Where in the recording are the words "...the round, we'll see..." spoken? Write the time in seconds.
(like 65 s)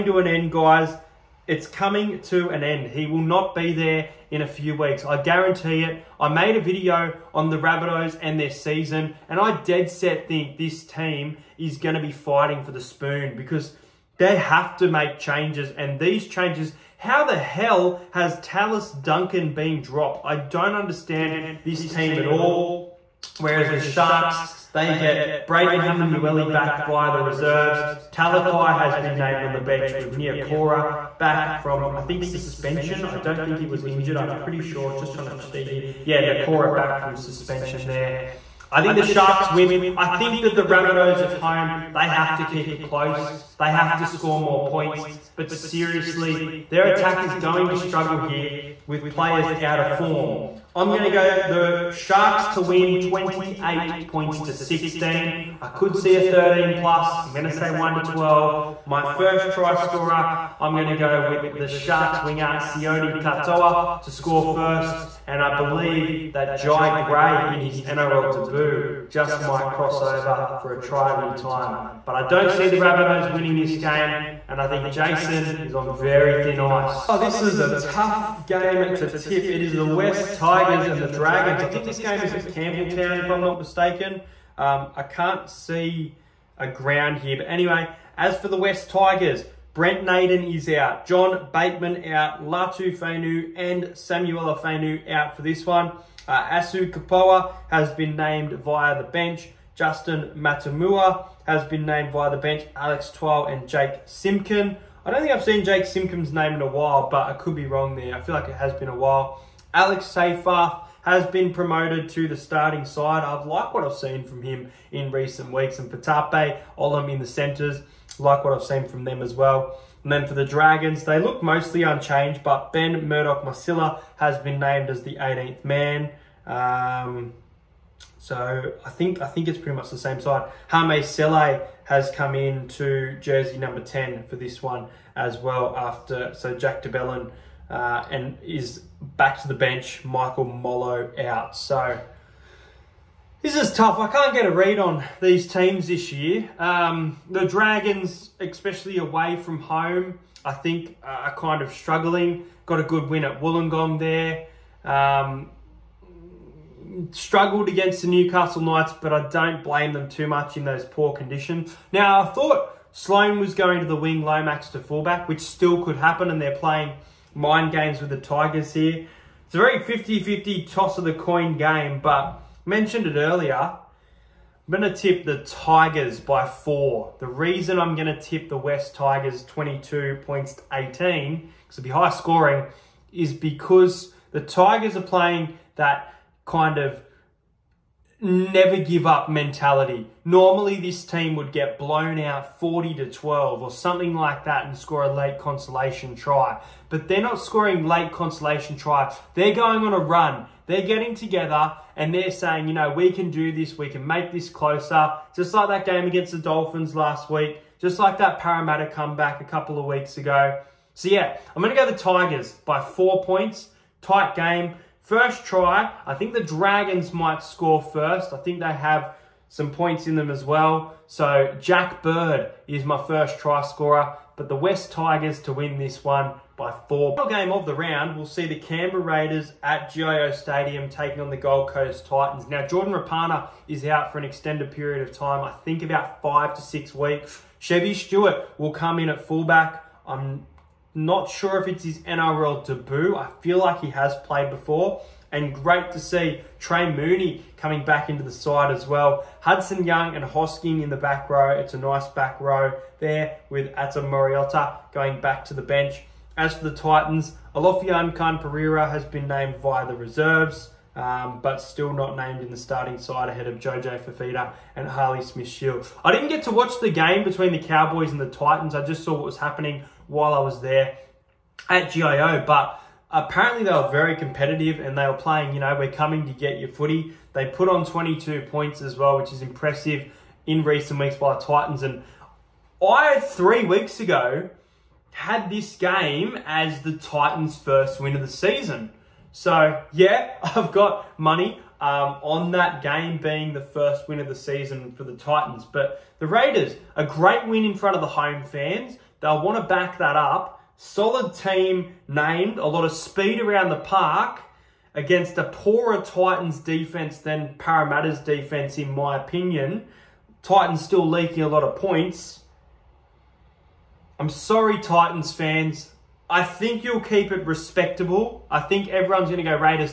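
227 s.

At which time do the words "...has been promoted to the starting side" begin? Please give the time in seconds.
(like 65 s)
111 s.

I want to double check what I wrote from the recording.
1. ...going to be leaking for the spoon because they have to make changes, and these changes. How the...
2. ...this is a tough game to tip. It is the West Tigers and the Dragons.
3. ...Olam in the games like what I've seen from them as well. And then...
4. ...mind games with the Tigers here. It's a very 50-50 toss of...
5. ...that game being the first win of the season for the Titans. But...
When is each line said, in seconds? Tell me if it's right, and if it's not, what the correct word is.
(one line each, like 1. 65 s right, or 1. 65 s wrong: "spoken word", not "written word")
1. 11 s wrong: "fighting", not "leaking"
2. 77 s right
3. 116 s wrong: "centres", not "games"
4. 167 s right
5. 292 s right.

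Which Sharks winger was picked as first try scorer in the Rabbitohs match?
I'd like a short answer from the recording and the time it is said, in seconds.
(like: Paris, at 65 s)
Sione Katoa, at 62 s.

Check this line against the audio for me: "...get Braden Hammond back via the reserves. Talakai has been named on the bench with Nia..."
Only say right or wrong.
right.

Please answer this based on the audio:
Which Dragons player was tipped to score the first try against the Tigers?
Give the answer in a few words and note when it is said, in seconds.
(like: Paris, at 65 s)
Jack Bird, at 221 s.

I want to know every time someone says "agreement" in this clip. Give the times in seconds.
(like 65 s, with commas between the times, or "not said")
not said.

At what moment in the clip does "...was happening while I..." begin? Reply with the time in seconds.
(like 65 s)
269 s.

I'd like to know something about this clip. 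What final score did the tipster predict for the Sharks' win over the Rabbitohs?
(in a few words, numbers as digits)
28 to 16.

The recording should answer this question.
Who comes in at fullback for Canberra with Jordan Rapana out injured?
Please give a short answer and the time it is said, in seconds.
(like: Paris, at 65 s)
Chevy Stewart, at 237 s.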